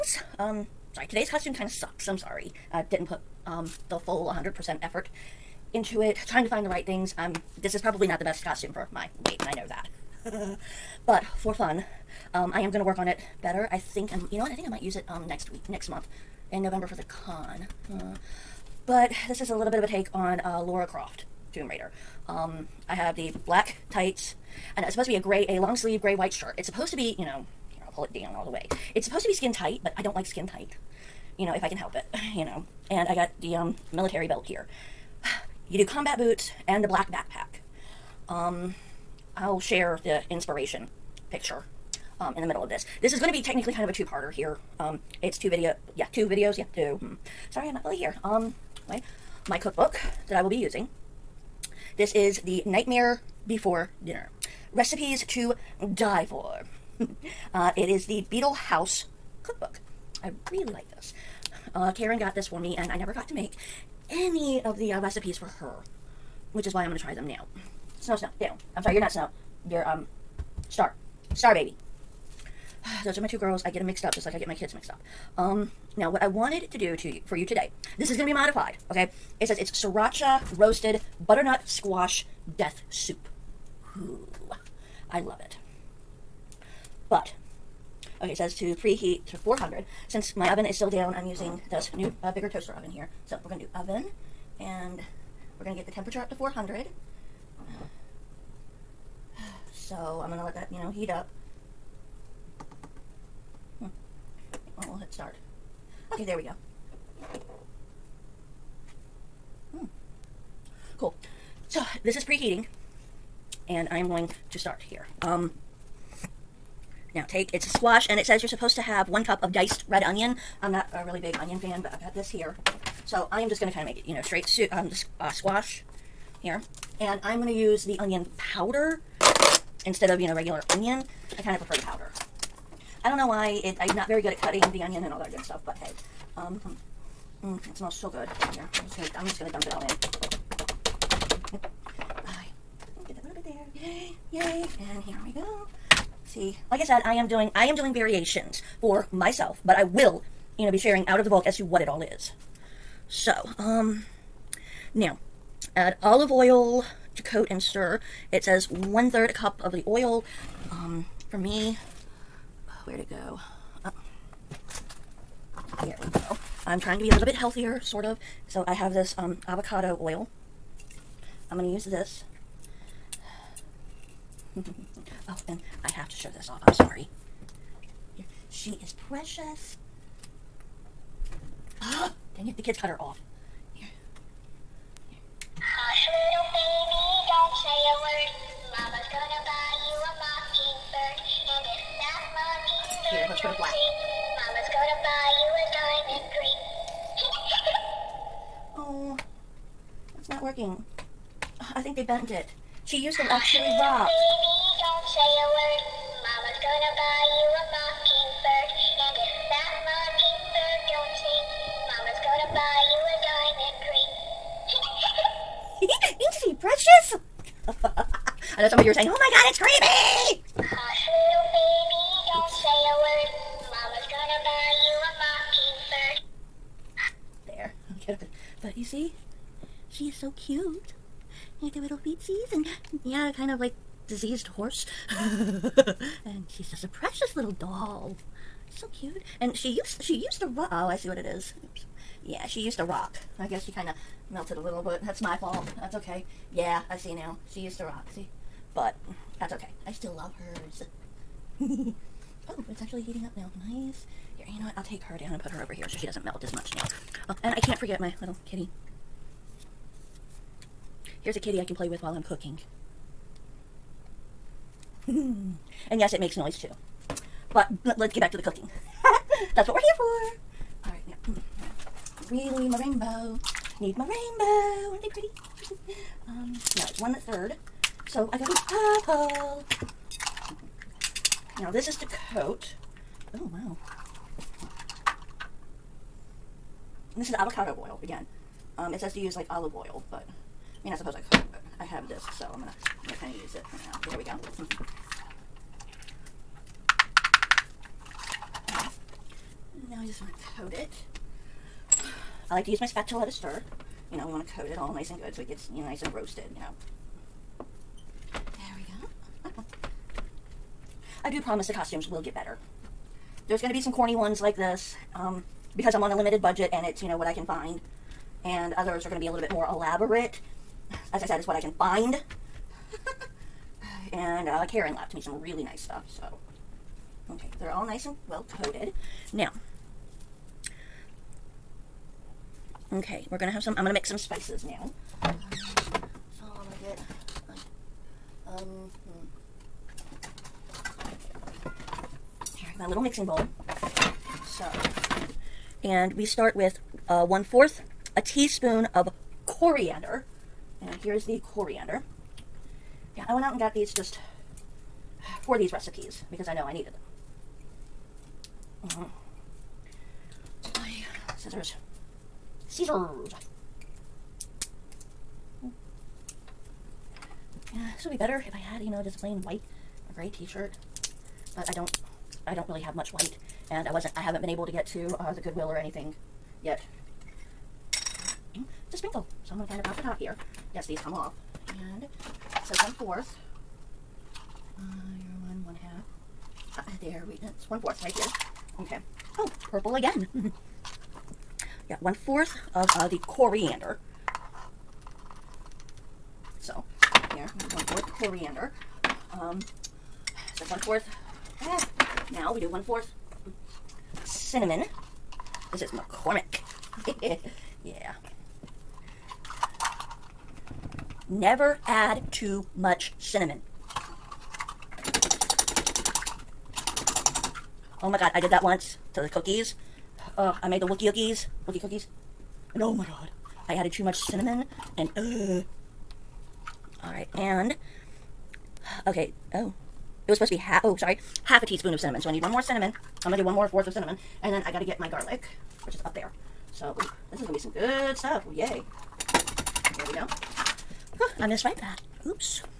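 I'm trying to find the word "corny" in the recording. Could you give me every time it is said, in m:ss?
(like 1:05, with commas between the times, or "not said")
5:13.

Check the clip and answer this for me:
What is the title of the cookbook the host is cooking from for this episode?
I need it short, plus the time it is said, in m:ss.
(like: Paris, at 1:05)
The Nightmare Before Dinner, at 0:52.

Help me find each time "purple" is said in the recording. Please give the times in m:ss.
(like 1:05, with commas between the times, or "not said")
4:39, 6:29.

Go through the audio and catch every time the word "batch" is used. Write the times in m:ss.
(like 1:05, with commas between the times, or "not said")
not said.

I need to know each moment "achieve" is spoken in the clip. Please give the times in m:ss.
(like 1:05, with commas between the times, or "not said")
not said.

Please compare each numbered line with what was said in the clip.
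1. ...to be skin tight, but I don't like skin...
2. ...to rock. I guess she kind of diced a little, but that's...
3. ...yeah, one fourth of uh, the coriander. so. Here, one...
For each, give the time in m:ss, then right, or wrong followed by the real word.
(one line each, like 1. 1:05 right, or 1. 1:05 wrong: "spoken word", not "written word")
1. 0:29 right
2. 4:02 wrong: "melted", not "diced"
3. 6:31 right.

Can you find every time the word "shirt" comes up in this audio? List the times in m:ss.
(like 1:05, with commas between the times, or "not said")
0:26, 6:10.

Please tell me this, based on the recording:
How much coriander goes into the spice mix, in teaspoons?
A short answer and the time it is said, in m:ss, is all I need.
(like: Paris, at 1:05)
1/4 teaspoon, at 5:47.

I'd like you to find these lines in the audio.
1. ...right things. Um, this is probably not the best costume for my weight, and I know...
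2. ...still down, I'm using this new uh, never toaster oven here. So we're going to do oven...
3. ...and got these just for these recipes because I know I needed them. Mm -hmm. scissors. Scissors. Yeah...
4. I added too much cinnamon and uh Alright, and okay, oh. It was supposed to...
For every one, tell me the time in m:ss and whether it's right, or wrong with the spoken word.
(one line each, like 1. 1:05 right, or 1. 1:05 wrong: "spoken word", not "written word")
1. 0:06 right
2. 1:30 wrong: "bigger", not "never"
3. 5:53 right
4. 7:03 right.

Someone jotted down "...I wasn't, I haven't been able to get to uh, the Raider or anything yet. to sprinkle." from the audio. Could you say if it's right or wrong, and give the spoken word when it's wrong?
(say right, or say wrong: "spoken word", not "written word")
wrong: "Goodwill", not "Raider".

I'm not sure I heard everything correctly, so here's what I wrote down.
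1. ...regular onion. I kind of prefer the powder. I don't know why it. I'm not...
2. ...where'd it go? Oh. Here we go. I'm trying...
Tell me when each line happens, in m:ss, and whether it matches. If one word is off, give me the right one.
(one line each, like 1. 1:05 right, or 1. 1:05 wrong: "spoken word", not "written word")
1. 2:10 right
2. 2:42 right.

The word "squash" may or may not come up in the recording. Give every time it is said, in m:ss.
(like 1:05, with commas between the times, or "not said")
1:21, 1:57, 2:05.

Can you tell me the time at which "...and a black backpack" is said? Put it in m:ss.
0:36.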